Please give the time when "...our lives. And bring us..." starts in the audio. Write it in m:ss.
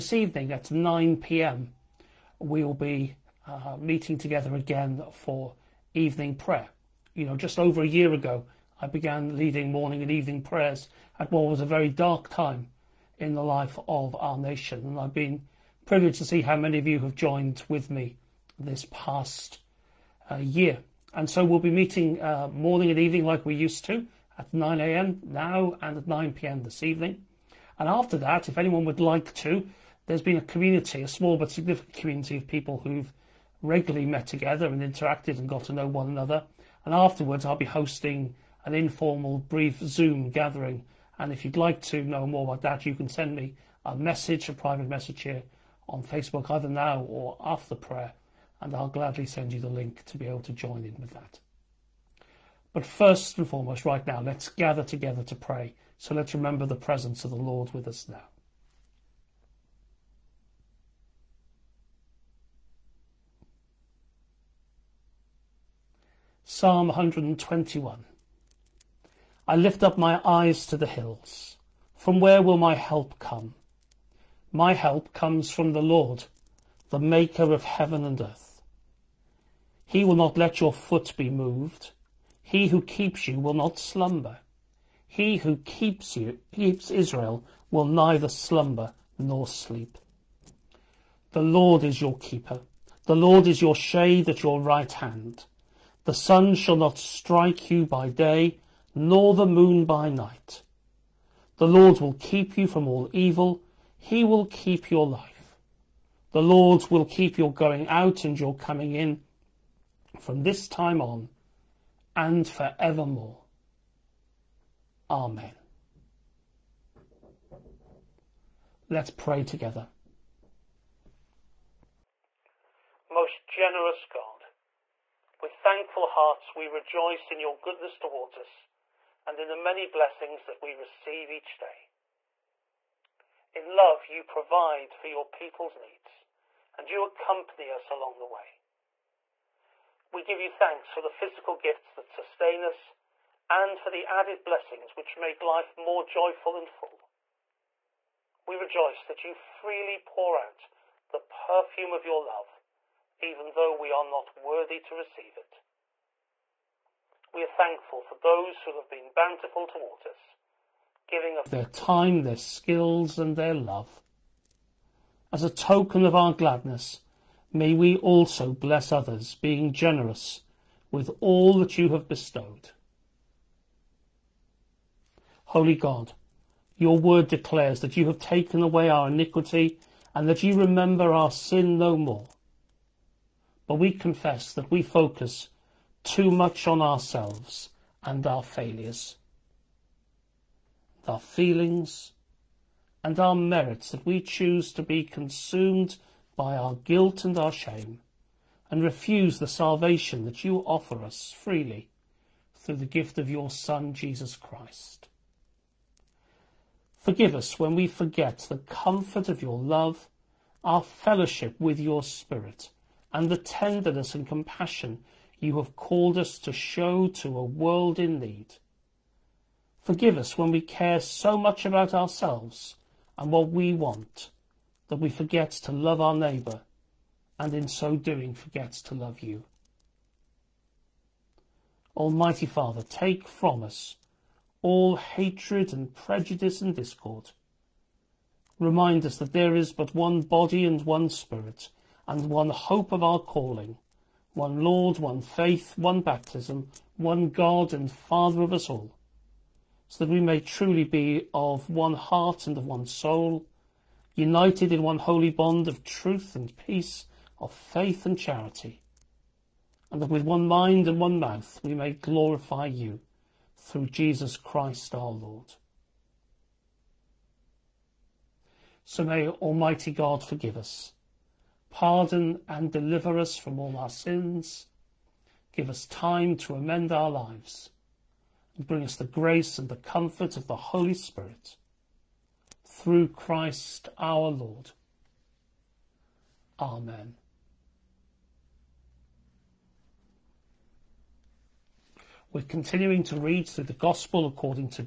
4:36.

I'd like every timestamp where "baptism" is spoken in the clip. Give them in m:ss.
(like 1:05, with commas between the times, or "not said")
4:06.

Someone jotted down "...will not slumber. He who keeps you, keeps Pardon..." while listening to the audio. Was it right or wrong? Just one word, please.
wrong.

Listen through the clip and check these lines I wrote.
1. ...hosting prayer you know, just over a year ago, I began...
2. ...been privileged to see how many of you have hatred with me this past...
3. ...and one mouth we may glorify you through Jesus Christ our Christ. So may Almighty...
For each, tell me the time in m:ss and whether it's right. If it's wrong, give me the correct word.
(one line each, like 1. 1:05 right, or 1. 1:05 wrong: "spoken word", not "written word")
1. 0:05 wrong: "evening", not "hosting"
2. 0:15 wrong: "joined", not "hatred"
3. 4:20 wrong: "Lord", not "Christ".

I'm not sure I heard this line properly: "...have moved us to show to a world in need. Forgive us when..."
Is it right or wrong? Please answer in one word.
wrong.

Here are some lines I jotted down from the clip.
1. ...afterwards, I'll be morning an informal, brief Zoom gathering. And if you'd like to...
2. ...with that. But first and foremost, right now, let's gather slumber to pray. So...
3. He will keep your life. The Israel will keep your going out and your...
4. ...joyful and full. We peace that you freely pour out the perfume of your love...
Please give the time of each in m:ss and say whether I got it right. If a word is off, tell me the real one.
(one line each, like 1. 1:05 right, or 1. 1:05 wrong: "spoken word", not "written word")
1. 0:36 wrong: "hosting", not "morning"
2. 0:50 wrong: "together", not "slumber"
3. 1:43 wrong: "Lord", not "Israel"
4. 2:26 wrong: "rejoice", not "peace".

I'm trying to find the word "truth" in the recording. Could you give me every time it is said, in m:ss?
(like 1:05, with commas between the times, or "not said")
4:15.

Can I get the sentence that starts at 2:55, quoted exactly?
Holy God, your word declares that you have taken away our iniquity and that you remember our sin no more.